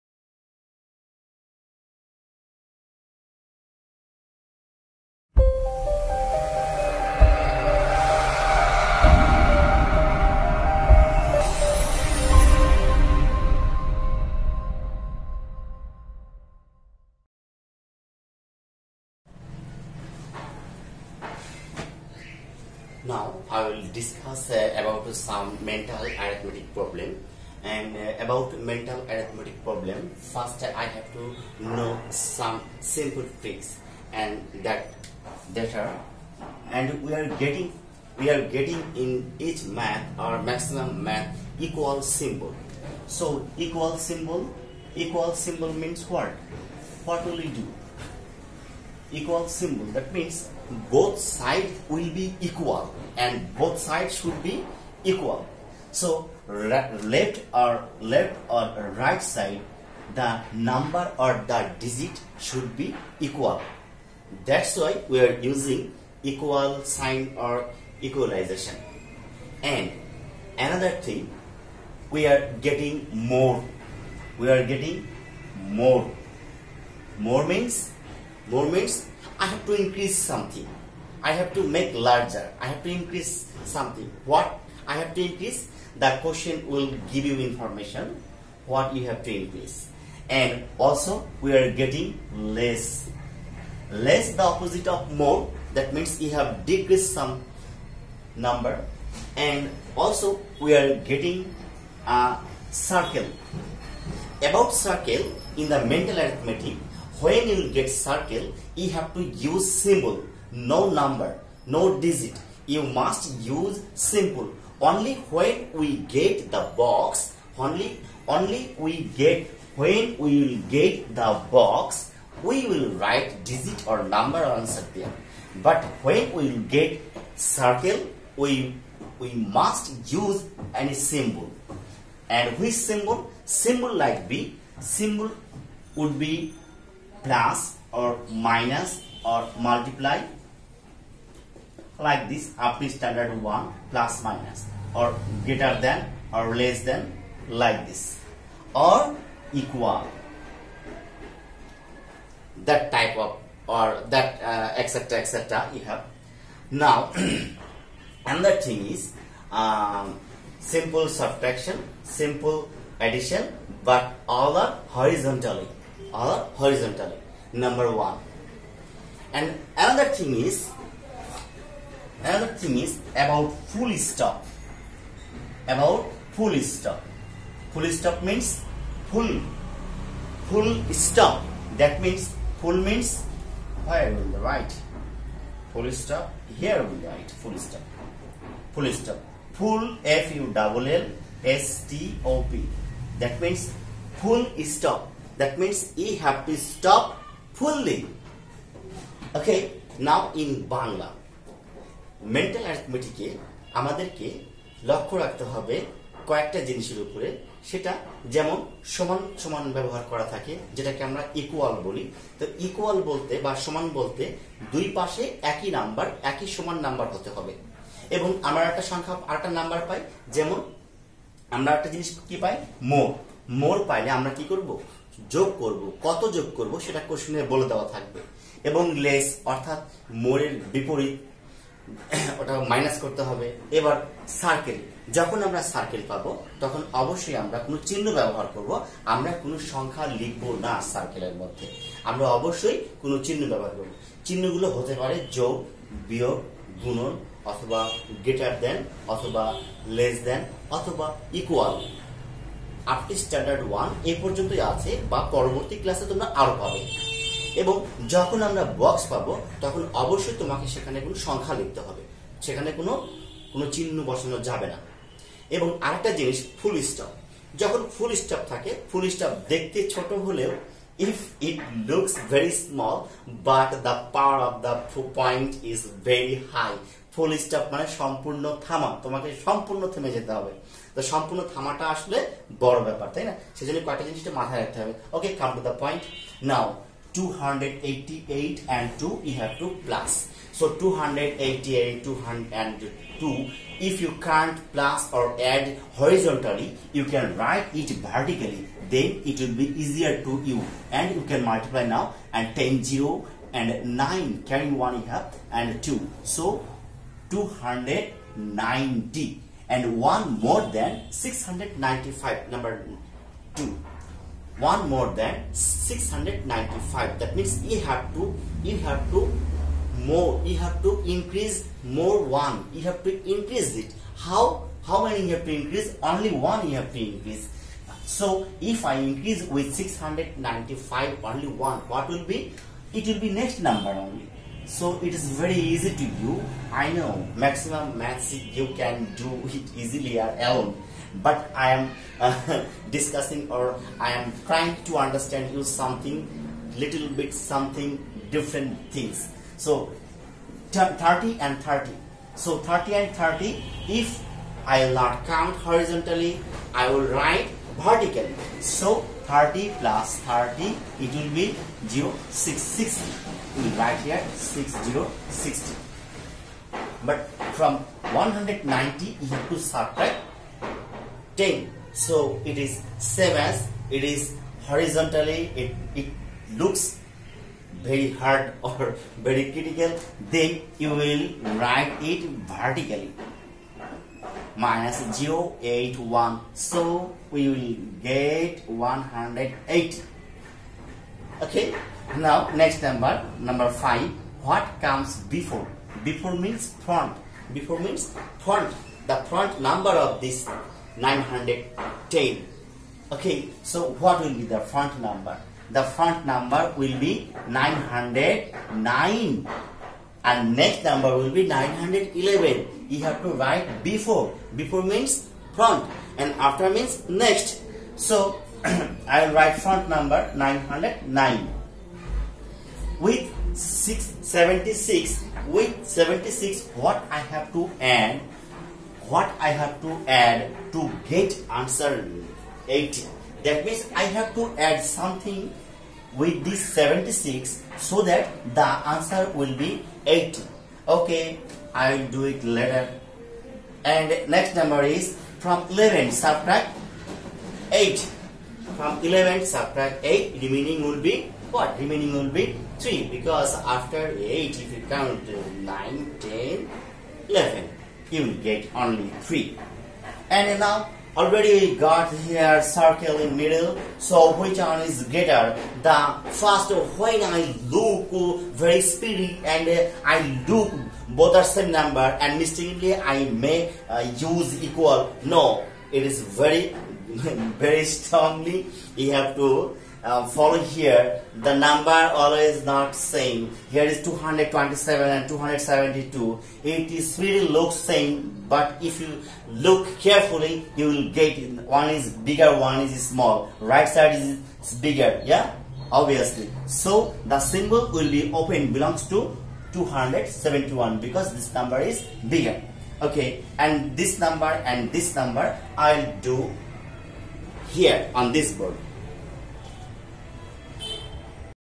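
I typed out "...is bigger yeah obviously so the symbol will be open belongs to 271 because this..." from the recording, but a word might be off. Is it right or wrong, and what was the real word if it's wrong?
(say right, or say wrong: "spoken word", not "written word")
right.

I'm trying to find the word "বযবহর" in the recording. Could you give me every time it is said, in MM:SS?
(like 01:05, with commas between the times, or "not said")
03:29, 03:58, 04:03.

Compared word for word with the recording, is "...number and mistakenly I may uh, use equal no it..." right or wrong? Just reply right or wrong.
right.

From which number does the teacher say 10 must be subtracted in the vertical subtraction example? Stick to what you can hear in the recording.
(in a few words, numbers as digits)
190.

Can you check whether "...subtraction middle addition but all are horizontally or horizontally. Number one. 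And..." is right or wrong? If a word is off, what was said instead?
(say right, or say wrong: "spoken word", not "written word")
wrong: "simple", not "middle".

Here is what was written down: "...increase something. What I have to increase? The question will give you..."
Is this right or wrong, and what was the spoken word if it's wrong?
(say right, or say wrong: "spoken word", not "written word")
right.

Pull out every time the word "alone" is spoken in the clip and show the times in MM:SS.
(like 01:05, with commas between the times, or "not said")
05:40.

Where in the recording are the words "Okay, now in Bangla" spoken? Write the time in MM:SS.
03:19.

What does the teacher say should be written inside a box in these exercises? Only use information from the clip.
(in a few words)
digit or number.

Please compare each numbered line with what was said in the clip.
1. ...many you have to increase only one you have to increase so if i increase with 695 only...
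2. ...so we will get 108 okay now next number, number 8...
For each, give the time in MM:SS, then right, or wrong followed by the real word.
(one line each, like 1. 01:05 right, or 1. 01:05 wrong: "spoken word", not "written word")
1. 05:25 right
2. 06:26 wrong: "5", not "8".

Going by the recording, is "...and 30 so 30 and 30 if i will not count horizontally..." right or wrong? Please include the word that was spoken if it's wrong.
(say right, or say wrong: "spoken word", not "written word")
right.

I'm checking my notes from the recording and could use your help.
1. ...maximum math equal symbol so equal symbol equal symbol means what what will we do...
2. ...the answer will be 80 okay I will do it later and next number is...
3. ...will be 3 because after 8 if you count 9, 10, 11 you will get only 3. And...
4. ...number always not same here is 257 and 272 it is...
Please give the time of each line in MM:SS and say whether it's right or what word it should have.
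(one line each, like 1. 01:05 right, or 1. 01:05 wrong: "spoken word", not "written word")
1. 00:40 right
2. 07:18 right
3. 07:32 right
4. 08:01 wrong: "227", not "257".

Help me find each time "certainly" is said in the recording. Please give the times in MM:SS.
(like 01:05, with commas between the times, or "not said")
not said.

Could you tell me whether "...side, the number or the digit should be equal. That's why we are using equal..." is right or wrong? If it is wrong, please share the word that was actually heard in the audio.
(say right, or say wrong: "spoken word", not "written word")
right.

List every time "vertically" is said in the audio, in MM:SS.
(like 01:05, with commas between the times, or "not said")
04:58, 05:57, 06:22.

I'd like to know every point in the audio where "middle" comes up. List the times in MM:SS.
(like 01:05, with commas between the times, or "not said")
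07:43.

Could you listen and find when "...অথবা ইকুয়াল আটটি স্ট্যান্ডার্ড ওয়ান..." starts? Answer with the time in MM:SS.
04:10.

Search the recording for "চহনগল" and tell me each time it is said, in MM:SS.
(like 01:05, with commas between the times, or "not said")
04:04.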